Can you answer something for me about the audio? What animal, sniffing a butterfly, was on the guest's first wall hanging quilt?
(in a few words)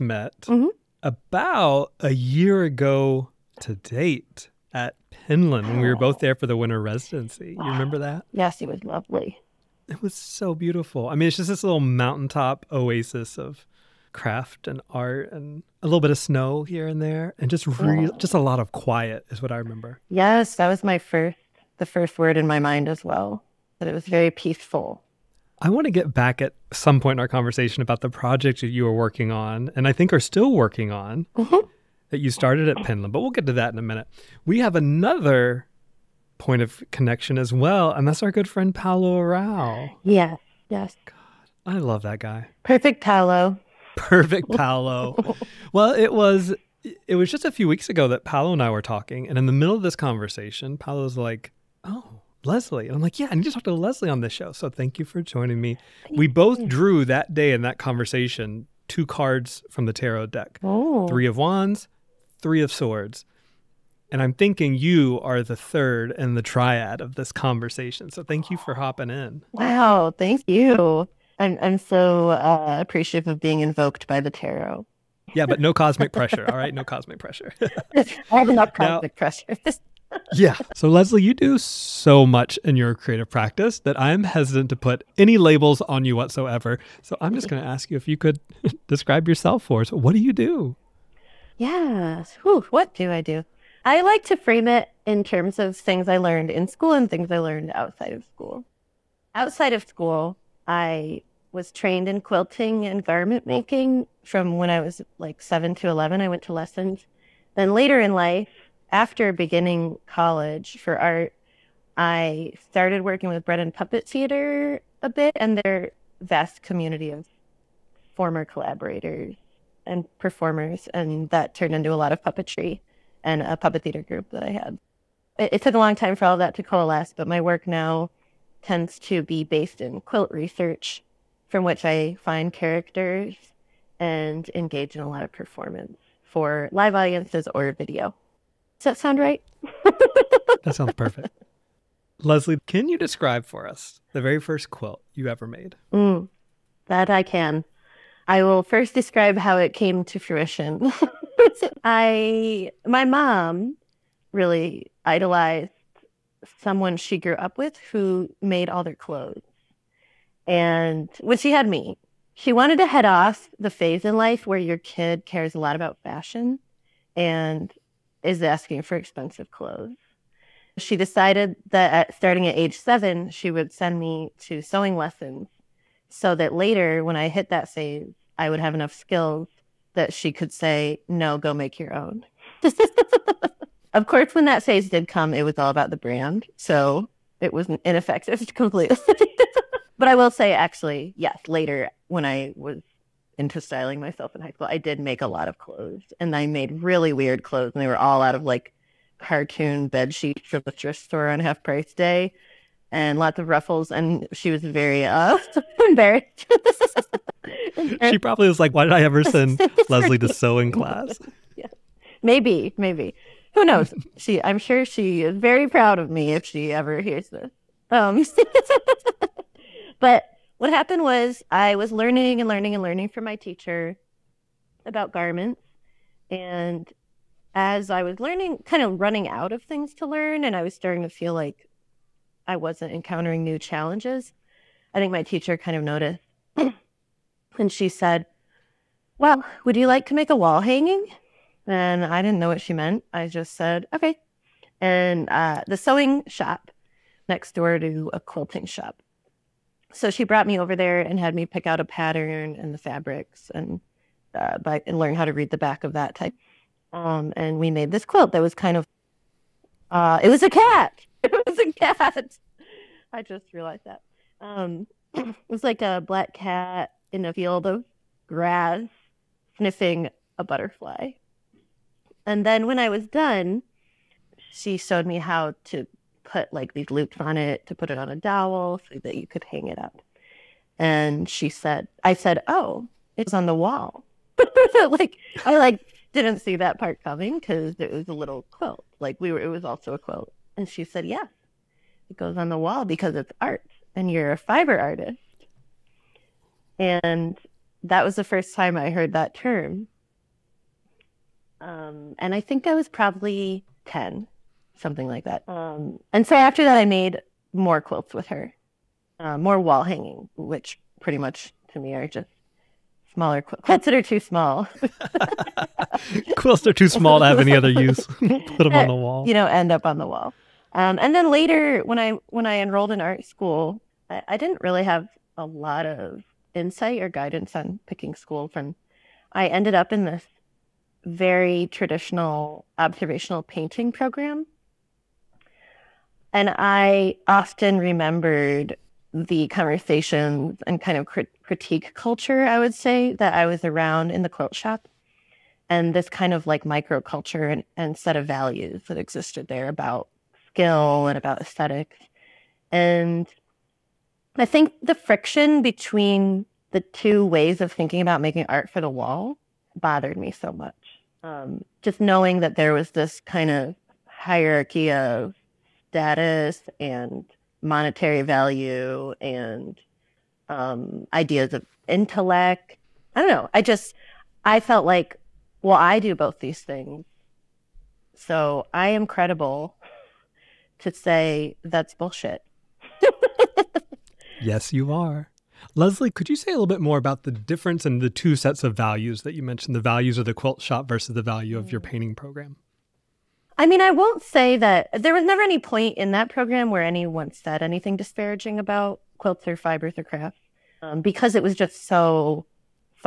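A black cat.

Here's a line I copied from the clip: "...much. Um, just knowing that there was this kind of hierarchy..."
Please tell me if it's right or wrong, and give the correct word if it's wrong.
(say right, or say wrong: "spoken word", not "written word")
right.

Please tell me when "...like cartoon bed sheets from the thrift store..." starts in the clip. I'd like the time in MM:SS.
03:18.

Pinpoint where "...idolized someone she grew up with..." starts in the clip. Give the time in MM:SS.
02:35.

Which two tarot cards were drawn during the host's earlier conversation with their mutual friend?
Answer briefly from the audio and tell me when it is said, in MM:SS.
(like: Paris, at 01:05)
Three of wands, three of swords, at 01:01.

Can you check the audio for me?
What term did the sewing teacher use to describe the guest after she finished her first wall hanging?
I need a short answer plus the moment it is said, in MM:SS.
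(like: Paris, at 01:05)
Fiber artist, at 04:54.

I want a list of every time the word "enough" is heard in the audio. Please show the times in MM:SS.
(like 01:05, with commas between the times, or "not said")
01:18, 02:58.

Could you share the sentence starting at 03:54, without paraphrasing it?
I think my teacher kind of noticed.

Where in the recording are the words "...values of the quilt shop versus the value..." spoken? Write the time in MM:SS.
06:29.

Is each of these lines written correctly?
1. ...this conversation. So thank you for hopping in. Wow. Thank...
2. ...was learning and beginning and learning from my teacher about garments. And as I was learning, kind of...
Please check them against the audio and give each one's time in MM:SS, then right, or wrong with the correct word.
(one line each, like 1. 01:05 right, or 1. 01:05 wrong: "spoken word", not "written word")
1. 01:07 right
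2. 03:41 wrong: "learning", not "beginning".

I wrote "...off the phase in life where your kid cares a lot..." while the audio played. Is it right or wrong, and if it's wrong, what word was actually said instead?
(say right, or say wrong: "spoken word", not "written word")
right.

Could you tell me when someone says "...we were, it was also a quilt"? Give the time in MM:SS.
04:49.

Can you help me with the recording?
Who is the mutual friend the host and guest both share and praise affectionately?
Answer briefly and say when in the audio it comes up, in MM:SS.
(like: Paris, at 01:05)
Paolo Arao, at 00:38.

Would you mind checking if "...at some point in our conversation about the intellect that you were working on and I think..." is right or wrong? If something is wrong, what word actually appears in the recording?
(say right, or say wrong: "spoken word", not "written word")
wrong: "project", not "intellect".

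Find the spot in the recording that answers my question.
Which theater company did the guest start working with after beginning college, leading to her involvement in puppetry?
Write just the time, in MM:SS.
01:53.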